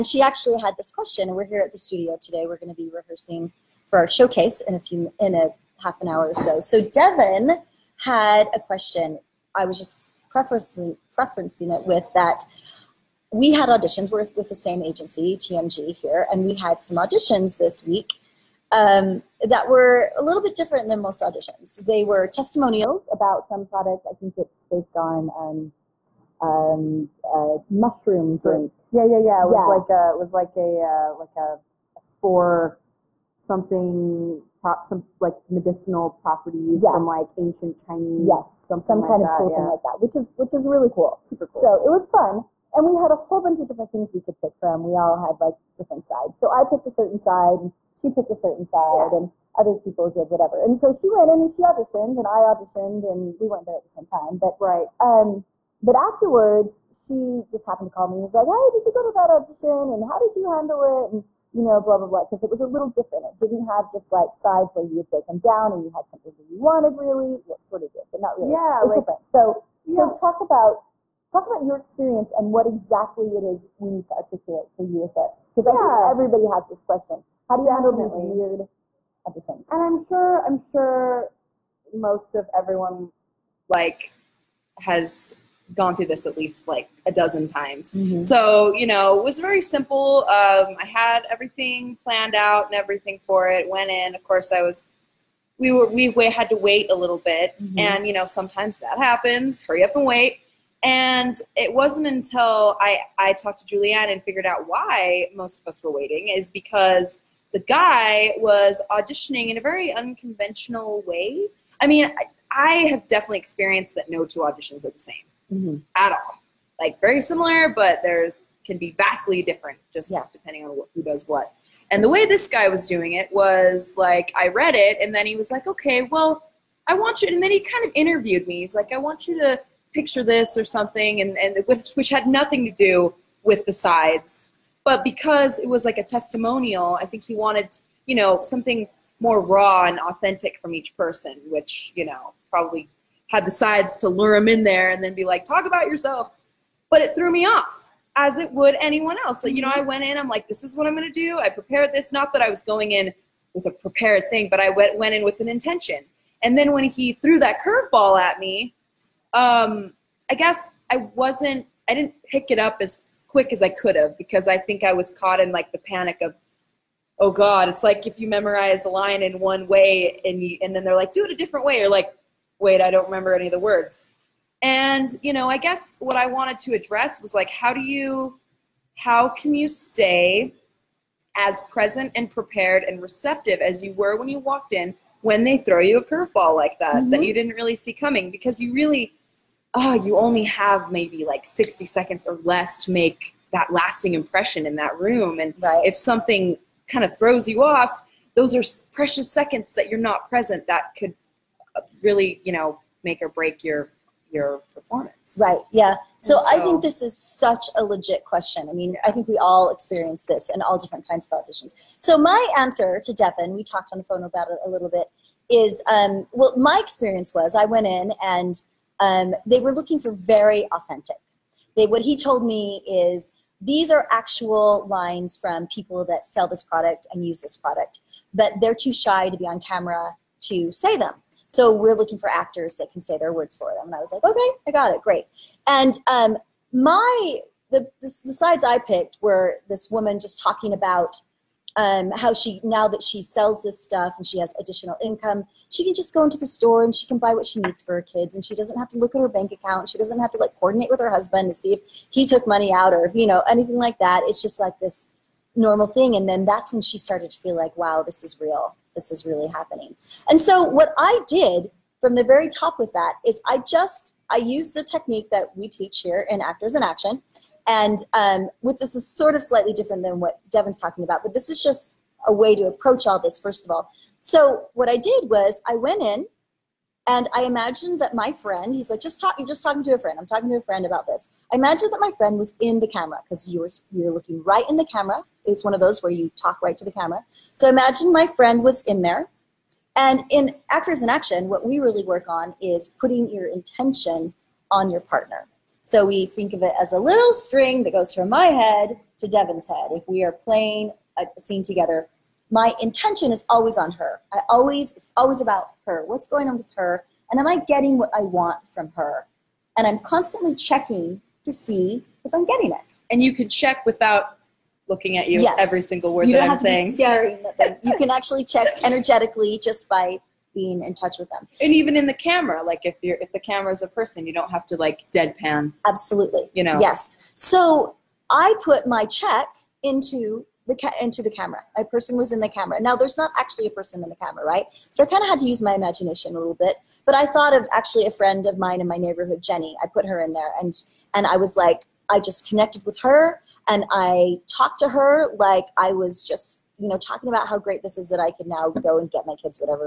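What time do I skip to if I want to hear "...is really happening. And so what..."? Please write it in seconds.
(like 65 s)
259 s.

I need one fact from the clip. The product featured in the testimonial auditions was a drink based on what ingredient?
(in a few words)
mushroom.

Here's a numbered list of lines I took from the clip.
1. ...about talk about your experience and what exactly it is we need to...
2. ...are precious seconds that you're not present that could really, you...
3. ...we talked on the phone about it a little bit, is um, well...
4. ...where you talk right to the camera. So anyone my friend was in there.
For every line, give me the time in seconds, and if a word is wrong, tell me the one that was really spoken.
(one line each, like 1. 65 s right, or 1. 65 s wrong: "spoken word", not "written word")
1. 70 s right
2. 198 s right
3. 213 s right
4. 286 s wrong: "imagine", not "anyone".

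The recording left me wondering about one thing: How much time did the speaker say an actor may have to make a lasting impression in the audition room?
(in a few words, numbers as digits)
60 seconds.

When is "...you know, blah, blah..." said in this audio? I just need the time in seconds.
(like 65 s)
61 s.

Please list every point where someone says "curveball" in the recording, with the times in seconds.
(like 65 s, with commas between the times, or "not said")
157 s, 186 s.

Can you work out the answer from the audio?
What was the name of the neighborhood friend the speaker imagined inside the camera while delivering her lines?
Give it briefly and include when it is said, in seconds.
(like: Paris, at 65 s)
Jenny, at 339 s.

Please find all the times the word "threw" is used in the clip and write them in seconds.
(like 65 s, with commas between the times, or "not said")
147 s, 157 s.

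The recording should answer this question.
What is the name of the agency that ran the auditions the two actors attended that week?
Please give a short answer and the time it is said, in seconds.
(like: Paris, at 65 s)
TMG, at 15 s.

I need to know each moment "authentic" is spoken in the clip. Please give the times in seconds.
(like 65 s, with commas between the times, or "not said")
139 s, 220 s.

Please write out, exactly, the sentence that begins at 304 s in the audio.
I always, it's always about her.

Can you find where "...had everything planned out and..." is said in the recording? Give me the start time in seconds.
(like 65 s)
90 s.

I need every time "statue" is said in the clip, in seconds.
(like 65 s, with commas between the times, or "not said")
not said.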